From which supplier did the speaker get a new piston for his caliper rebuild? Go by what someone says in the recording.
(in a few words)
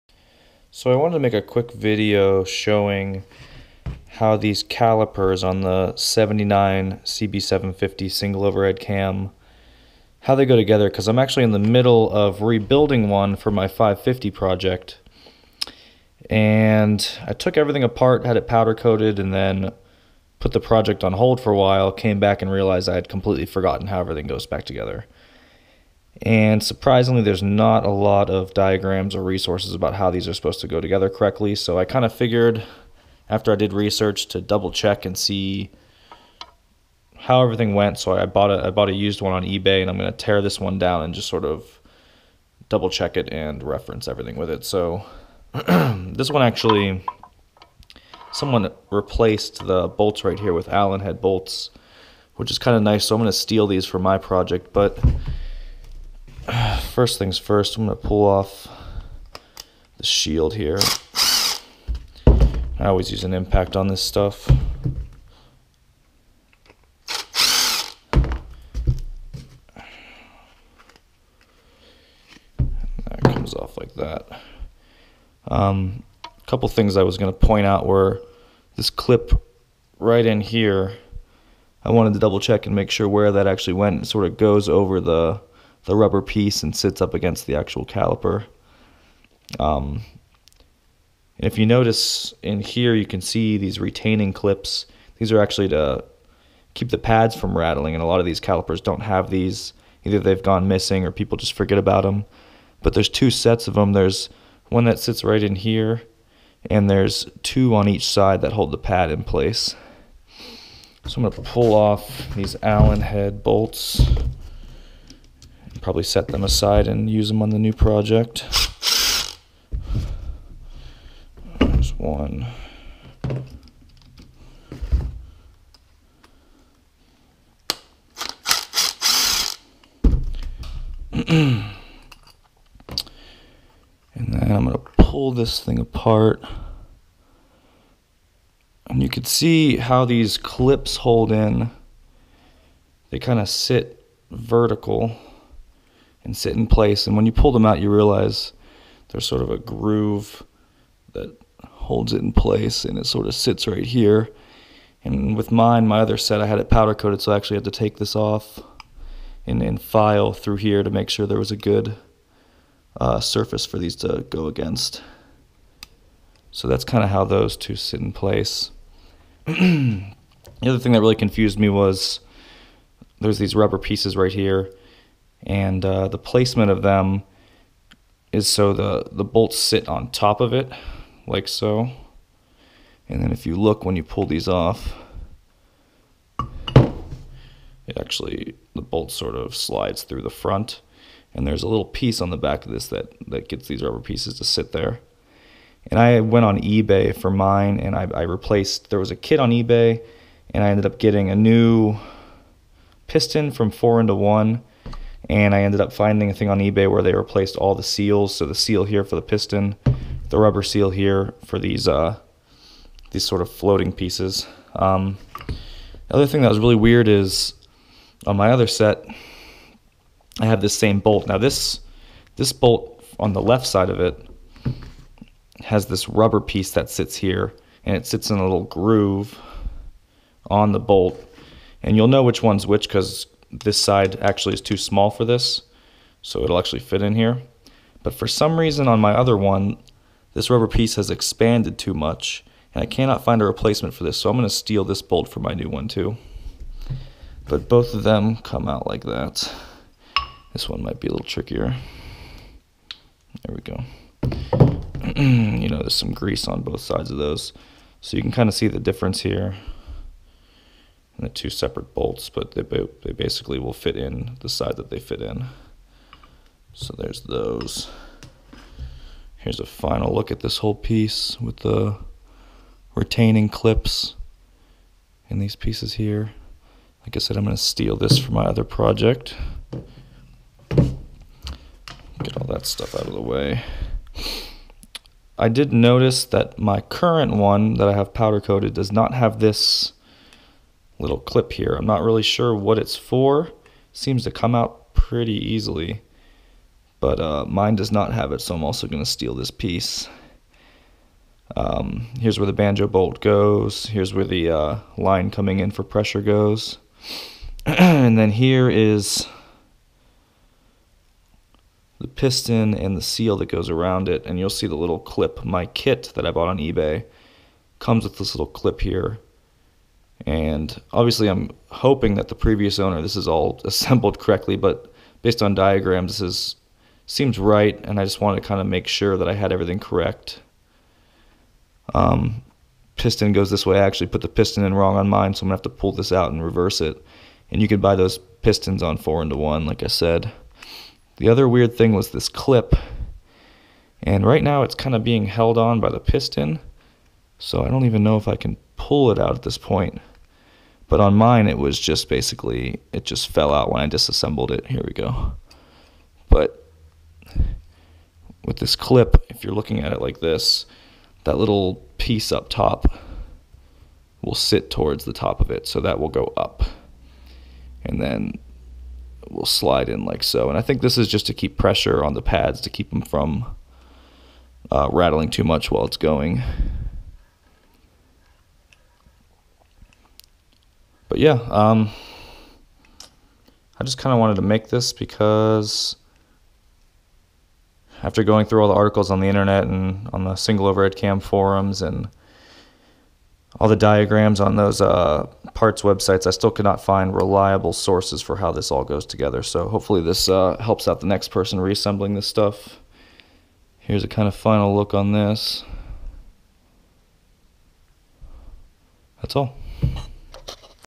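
4 into 1.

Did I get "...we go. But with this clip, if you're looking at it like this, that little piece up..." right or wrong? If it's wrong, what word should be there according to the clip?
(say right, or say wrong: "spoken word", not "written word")
right.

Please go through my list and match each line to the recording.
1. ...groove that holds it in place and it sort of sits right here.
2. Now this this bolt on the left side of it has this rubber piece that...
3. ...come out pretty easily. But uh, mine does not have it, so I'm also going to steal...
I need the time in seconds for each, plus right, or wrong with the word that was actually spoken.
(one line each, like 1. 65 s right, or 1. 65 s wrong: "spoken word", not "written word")
1. 149 s right
2. 221 s right
3. 294 s right.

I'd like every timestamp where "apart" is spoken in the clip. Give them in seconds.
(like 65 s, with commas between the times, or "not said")
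17 s, 135 s.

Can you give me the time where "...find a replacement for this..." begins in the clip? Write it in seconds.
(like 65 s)
243 s.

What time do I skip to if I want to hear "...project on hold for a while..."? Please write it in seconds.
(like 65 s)
20 s.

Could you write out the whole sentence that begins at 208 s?
So the seal here for the piston, the rubber seal here for these uh, these sort of floating pieces.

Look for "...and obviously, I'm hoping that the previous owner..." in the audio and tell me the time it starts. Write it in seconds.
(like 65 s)
320 s.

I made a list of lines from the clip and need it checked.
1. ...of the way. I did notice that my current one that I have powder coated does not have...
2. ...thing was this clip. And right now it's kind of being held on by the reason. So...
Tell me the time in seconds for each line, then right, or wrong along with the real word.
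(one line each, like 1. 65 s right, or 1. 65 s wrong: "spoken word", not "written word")
1. 283 s right
2. 341 s wrong: "piston", not "reason".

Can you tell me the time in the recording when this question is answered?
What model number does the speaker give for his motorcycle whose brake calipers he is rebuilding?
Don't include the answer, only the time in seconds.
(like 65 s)
13 s.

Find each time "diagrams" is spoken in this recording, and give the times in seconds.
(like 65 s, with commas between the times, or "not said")
28 s, 325 s, 393 s.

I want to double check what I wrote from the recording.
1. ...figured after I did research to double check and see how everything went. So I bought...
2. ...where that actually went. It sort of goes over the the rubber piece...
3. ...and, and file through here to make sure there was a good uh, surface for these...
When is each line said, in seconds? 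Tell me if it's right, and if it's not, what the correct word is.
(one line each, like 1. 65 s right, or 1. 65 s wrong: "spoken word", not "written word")
1. 32 s right
2. 83 s right
3. 159 s right.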